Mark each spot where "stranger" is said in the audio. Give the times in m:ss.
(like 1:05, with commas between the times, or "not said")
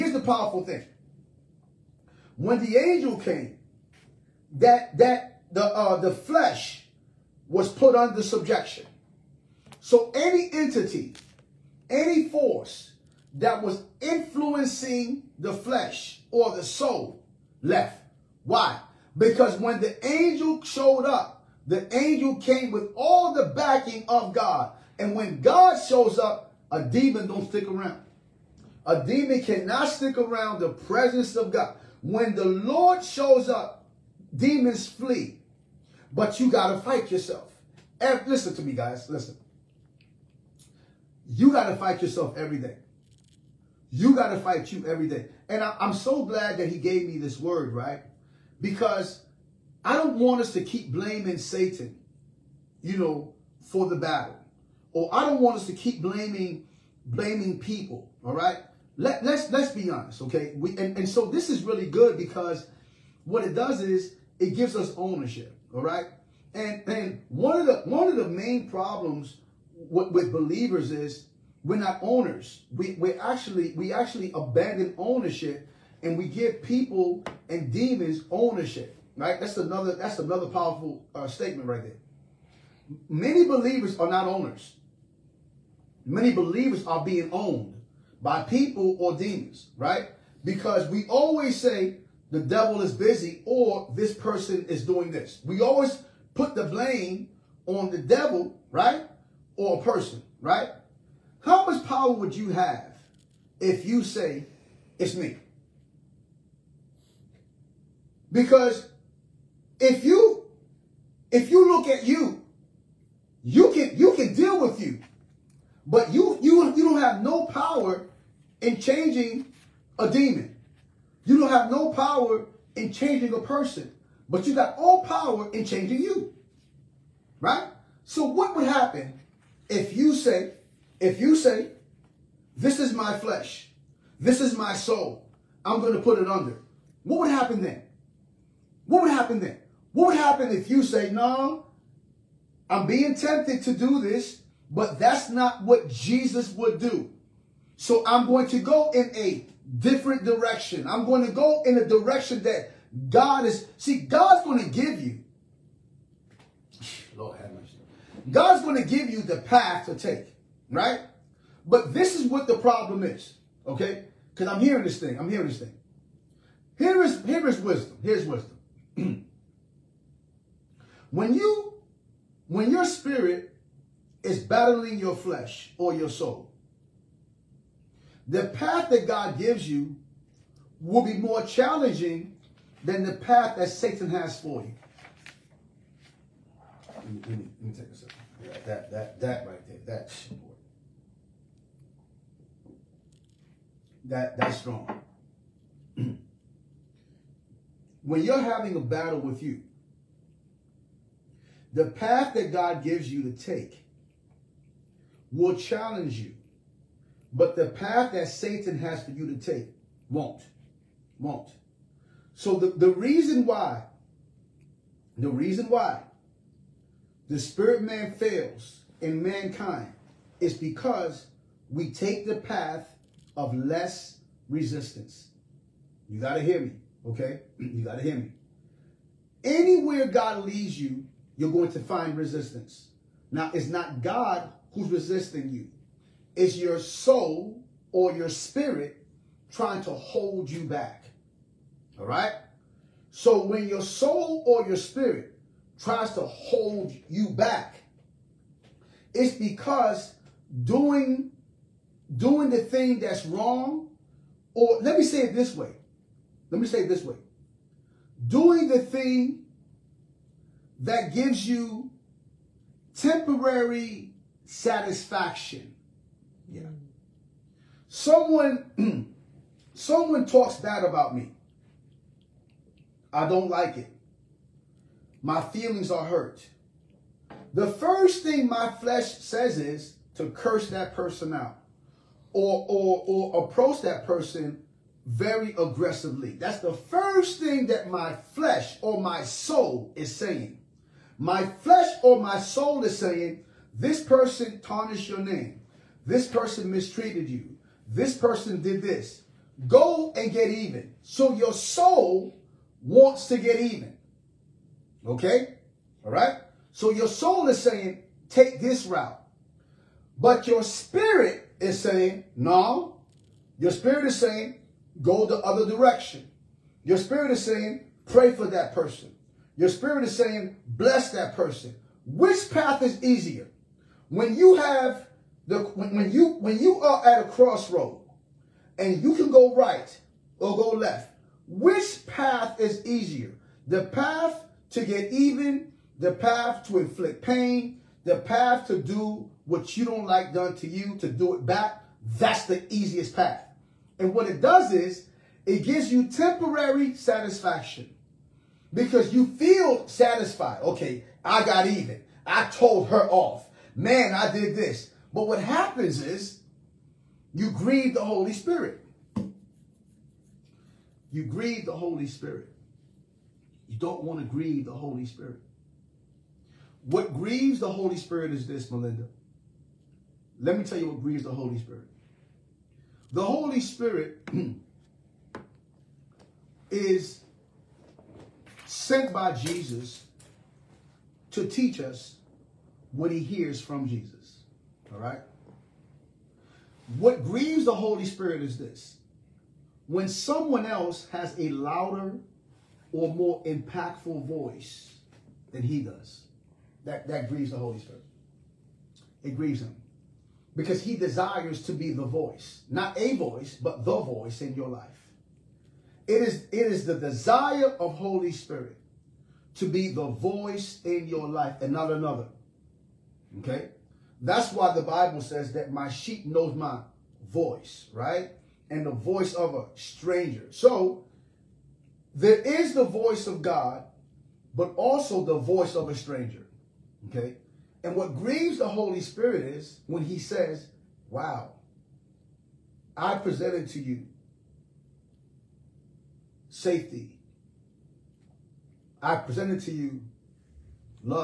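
6:59, 7:05.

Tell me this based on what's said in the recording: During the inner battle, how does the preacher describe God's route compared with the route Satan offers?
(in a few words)
Challenging.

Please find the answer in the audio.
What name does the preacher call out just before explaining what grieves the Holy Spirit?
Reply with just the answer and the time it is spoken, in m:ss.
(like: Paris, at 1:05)
Melinda, at 6:08.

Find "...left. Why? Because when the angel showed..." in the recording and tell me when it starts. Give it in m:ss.
0:17.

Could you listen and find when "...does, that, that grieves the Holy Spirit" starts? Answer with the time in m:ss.
6:35.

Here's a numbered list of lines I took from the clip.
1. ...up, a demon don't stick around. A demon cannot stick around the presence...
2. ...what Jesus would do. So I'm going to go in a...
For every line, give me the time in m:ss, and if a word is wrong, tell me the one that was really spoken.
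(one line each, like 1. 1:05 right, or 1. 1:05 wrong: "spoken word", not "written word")
1. 0:26 right
2. 2:25 right.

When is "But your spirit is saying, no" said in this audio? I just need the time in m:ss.
5:10.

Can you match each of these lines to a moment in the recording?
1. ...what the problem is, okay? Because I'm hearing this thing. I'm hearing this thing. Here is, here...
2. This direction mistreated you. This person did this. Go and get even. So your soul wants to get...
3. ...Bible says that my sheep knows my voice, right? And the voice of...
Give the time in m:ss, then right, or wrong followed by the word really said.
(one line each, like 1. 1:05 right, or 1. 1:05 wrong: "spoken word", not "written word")
1. 2:42 right
2. 4:56 wrong: "person", not "direction"
3. 6:54 right.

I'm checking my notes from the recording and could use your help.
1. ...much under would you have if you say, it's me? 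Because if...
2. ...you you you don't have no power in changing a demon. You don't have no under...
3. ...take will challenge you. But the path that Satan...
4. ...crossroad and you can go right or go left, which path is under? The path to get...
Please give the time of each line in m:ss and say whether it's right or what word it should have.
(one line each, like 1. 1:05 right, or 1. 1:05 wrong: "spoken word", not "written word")
1. 1:41 wrong: "power", not "under"
2. 1:56 wrong: "power", not "under"
3. 3:23 right
4. 5:27 wrong: "easier", not "under".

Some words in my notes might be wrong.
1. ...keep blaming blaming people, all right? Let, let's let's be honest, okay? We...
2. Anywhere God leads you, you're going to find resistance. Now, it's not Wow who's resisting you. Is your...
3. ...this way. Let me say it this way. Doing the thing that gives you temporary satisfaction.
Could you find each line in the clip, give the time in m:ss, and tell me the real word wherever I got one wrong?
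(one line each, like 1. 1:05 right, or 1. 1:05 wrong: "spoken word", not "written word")
1. 0:55 right
2. 3:49 wrong: "God", not "Wow"
3. 4:15 right.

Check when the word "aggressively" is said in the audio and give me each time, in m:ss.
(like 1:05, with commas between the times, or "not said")
4:45.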